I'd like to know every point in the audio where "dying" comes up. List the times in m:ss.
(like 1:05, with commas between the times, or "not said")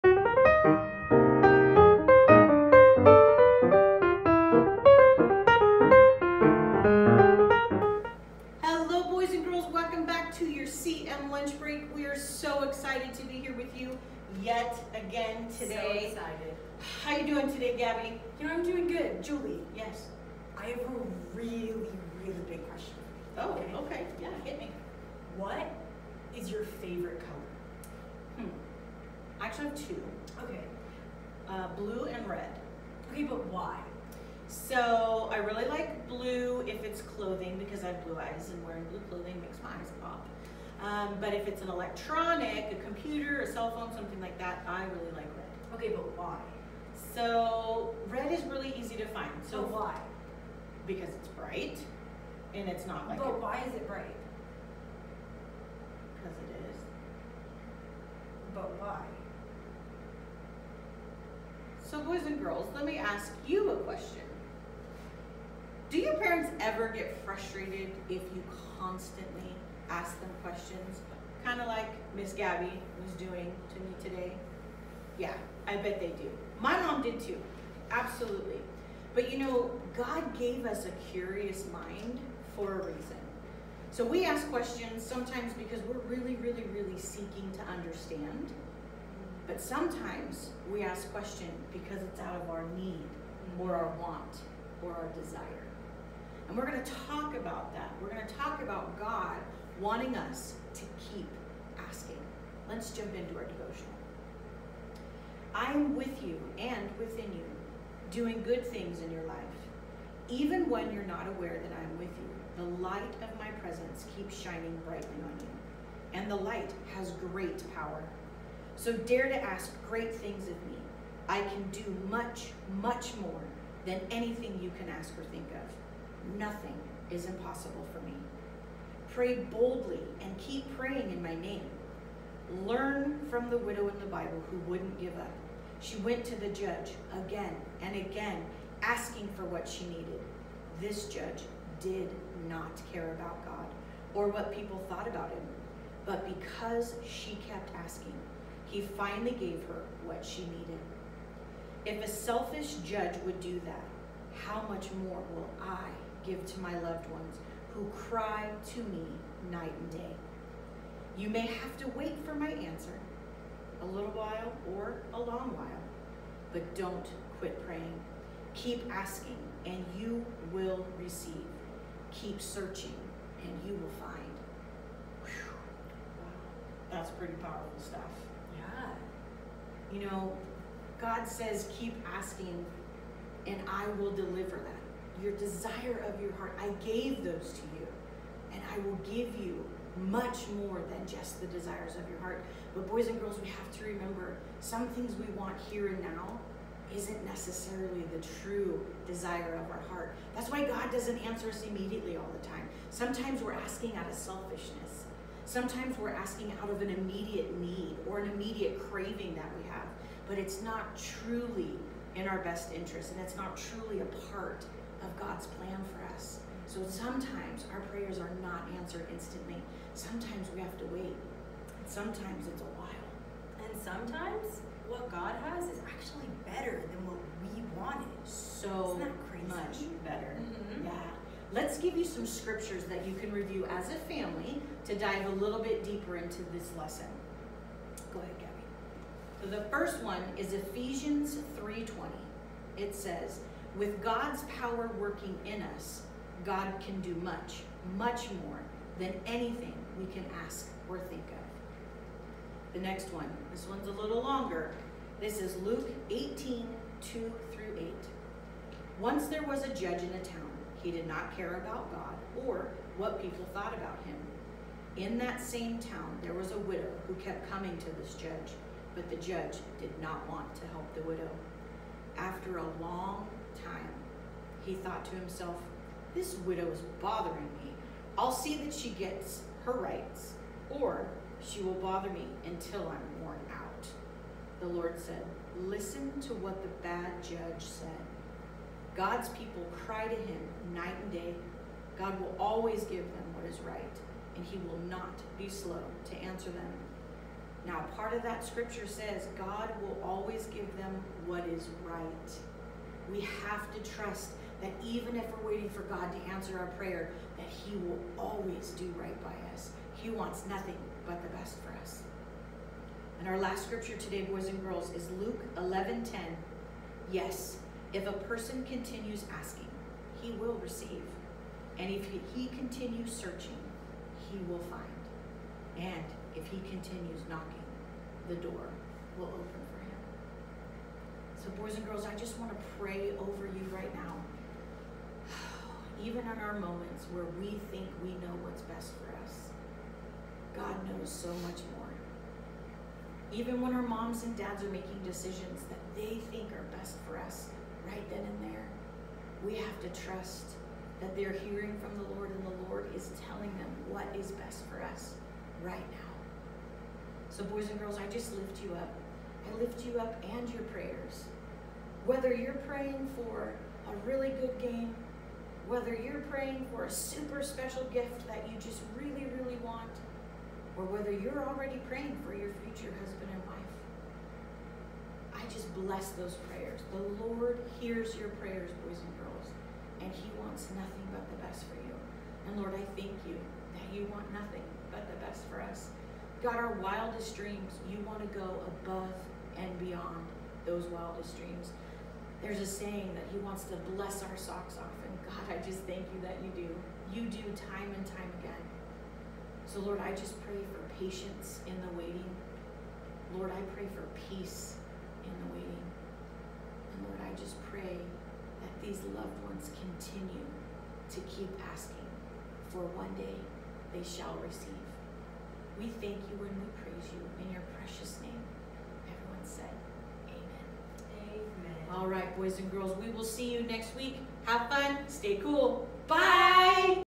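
not said.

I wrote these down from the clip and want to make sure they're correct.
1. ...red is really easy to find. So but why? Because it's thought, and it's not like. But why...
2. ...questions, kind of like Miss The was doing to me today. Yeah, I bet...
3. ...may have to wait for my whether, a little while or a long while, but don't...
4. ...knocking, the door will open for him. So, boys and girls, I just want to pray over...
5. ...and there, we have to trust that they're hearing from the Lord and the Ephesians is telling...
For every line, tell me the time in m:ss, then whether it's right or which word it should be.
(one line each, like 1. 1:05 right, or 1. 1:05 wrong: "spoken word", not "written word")
1. 0:48 wrong: "bright", not "thought"
2. 1:10 wrong: "Gabby", not "The"
3. 2:41 wrong: "answer", not "whether"
4. 5:27 right
5. 5:48 wrong: "Lord", not "Ephesians".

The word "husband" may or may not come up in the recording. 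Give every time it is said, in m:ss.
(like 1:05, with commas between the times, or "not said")
6:12.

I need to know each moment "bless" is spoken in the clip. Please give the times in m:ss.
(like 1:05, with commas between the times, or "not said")
6:15, 6:33.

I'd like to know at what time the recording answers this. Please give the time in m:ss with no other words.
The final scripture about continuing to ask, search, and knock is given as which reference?
5:15.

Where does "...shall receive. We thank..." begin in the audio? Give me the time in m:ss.
6:54.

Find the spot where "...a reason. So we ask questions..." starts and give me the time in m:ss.
1:22.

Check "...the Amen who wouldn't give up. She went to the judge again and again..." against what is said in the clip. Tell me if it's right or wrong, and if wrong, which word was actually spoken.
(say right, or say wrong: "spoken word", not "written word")
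wrong: "Bible", not "Amen".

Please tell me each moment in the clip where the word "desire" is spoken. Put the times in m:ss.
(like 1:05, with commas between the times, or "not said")
1:35, 3:05, 3:11, 3:19.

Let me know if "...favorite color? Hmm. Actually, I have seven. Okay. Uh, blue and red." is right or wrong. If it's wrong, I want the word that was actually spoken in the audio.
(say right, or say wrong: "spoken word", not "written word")
wrong: "two", not "seven".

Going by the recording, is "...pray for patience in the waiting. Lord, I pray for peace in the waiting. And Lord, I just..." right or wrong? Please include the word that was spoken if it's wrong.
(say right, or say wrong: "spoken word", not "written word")
right.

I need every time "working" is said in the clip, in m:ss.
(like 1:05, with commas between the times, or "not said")
4:04.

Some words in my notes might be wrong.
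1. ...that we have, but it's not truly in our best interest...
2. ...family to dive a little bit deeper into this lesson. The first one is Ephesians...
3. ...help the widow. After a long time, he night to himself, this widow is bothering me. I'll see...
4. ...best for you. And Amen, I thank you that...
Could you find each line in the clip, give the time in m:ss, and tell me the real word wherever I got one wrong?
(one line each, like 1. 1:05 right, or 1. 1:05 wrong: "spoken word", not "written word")
1. 3:29 right
2. 3:54 right
3. 4:30 wrong: "thought", not "night"
4. 6:21 wrong: "Lord", not "Amen".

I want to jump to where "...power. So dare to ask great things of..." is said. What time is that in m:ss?
1:57.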